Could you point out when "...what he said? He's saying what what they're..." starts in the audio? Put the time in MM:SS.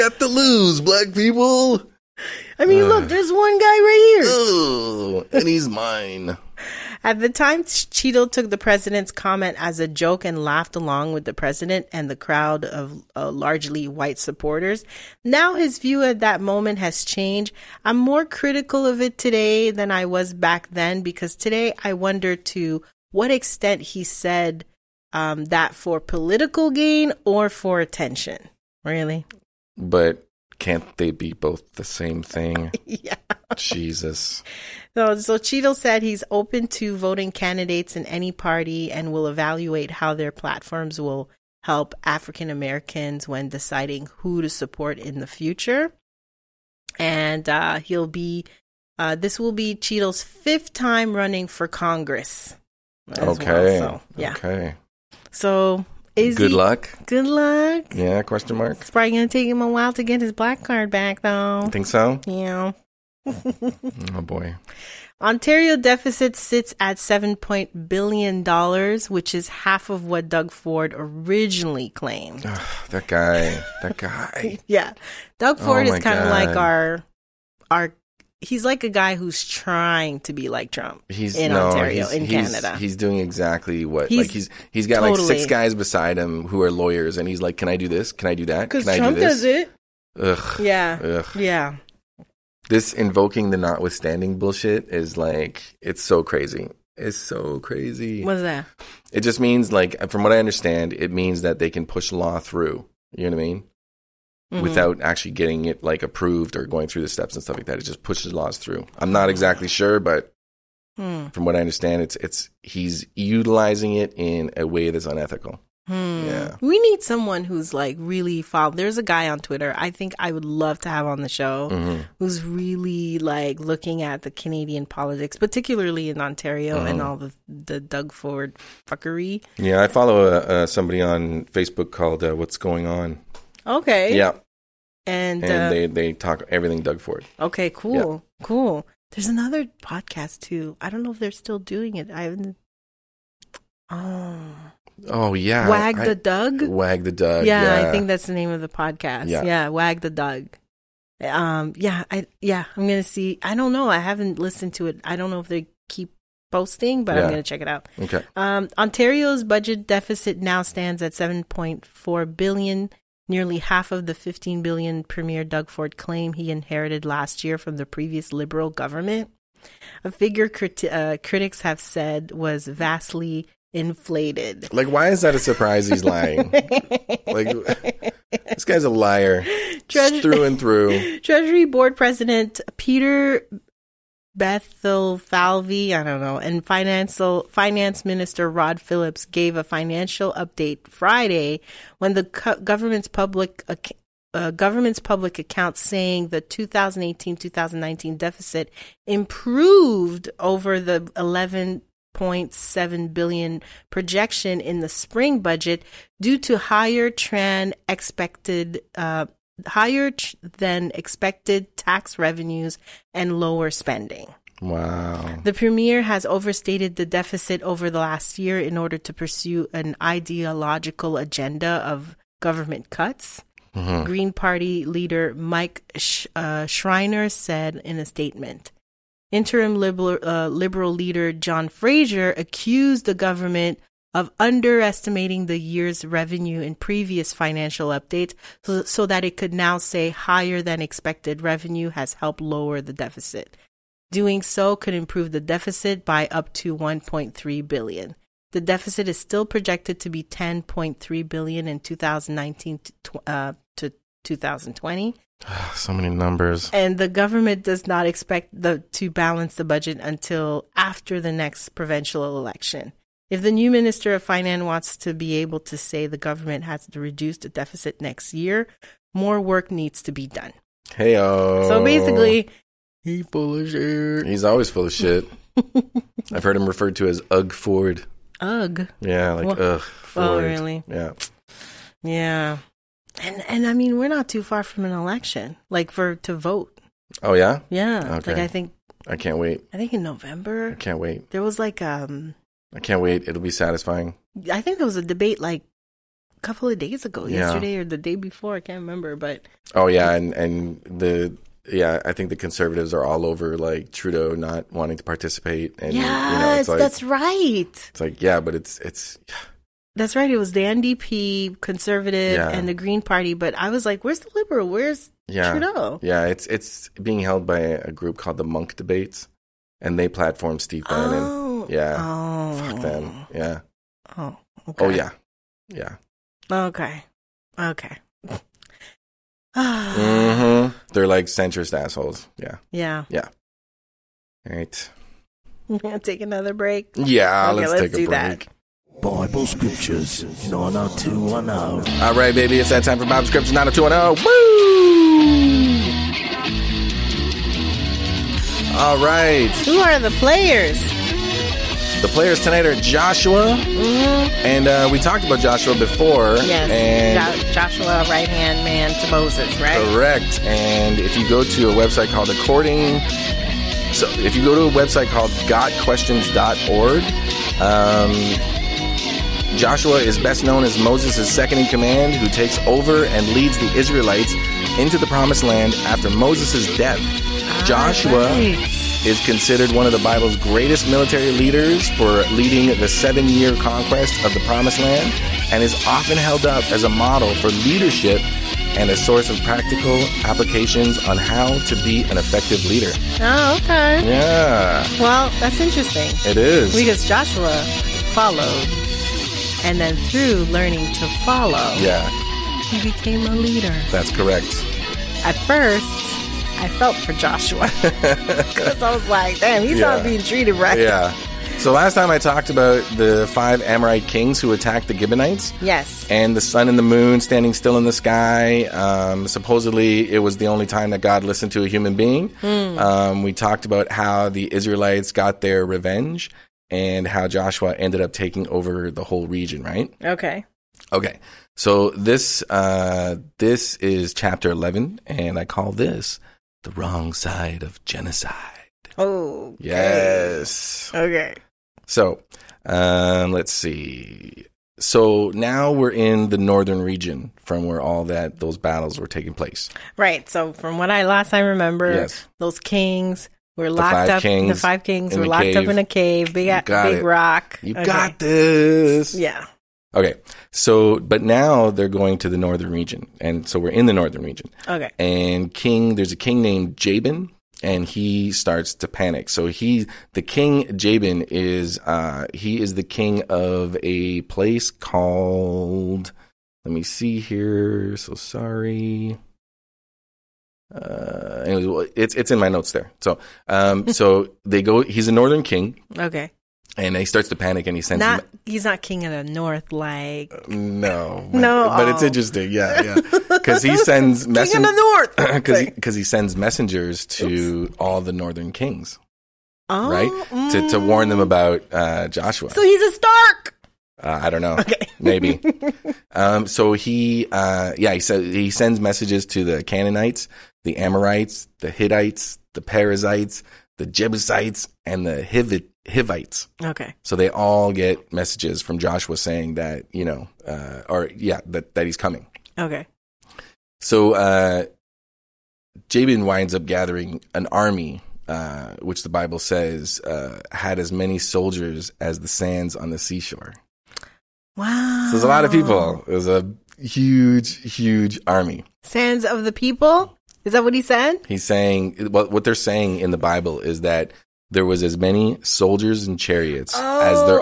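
09:00.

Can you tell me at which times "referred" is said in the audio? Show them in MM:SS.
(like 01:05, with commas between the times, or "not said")
04:36.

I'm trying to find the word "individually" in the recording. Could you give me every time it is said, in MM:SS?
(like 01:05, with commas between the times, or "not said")
not said.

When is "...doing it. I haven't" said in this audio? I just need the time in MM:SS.
02:21.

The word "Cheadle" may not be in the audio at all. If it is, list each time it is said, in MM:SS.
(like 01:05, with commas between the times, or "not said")
00:07, 00:35, 00:49.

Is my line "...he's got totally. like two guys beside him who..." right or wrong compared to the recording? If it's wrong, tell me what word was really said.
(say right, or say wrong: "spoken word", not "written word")
wrong: "six", not "two".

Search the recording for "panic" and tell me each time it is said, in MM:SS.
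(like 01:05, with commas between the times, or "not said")
07:48, 08:07.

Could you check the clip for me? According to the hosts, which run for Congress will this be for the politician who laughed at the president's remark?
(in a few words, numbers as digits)
fifth.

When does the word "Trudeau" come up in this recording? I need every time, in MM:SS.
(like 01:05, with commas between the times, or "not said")
05:03, 05:15.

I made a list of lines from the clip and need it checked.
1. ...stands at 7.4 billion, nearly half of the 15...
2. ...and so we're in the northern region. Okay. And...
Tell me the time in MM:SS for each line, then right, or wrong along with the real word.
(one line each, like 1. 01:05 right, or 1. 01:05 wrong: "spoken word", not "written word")
1. 02:40 right
2. 07:43 right.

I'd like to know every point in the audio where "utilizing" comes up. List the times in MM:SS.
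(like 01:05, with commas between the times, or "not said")
01:53.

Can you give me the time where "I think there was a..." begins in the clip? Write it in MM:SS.
04:54.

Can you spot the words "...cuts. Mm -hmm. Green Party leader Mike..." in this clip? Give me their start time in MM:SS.
03:42.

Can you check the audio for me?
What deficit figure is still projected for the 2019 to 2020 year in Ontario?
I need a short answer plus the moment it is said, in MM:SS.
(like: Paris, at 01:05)
10.3 billion, at 04:10.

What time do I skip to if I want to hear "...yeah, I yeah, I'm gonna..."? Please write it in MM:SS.
02:31.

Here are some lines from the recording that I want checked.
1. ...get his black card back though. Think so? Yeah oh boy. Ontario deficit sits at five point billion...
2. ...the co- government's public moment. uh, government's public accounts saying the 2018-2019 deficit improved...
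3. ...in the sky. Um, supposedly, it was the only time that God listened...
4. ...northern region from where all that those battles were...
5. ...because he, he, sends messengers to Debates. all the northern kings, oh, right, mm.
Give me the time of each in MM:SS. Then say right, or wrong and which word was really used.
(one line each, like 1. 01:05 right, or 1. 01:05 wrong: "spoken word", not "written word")
1. 01:00 wrong: "seven", not "five"
2. 03:12 wrong: "account", not "moment"
3. 06:57 right
4. 07:26 right
5. 08:15 wrong: "Oops", not "Debates".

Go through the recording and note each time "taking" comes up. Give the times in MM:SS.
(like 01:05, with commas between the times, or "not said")
07:08, 07:29.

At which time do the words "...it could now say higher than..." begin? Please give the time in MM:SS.
03:59.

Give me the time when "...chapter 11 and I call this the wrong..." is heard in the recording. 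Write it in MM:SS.
07:14.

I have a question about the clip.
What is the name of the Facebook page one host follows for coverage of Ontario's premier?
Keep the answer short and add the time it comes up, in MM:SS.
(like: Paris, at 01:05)
What's Going On, at 02:12.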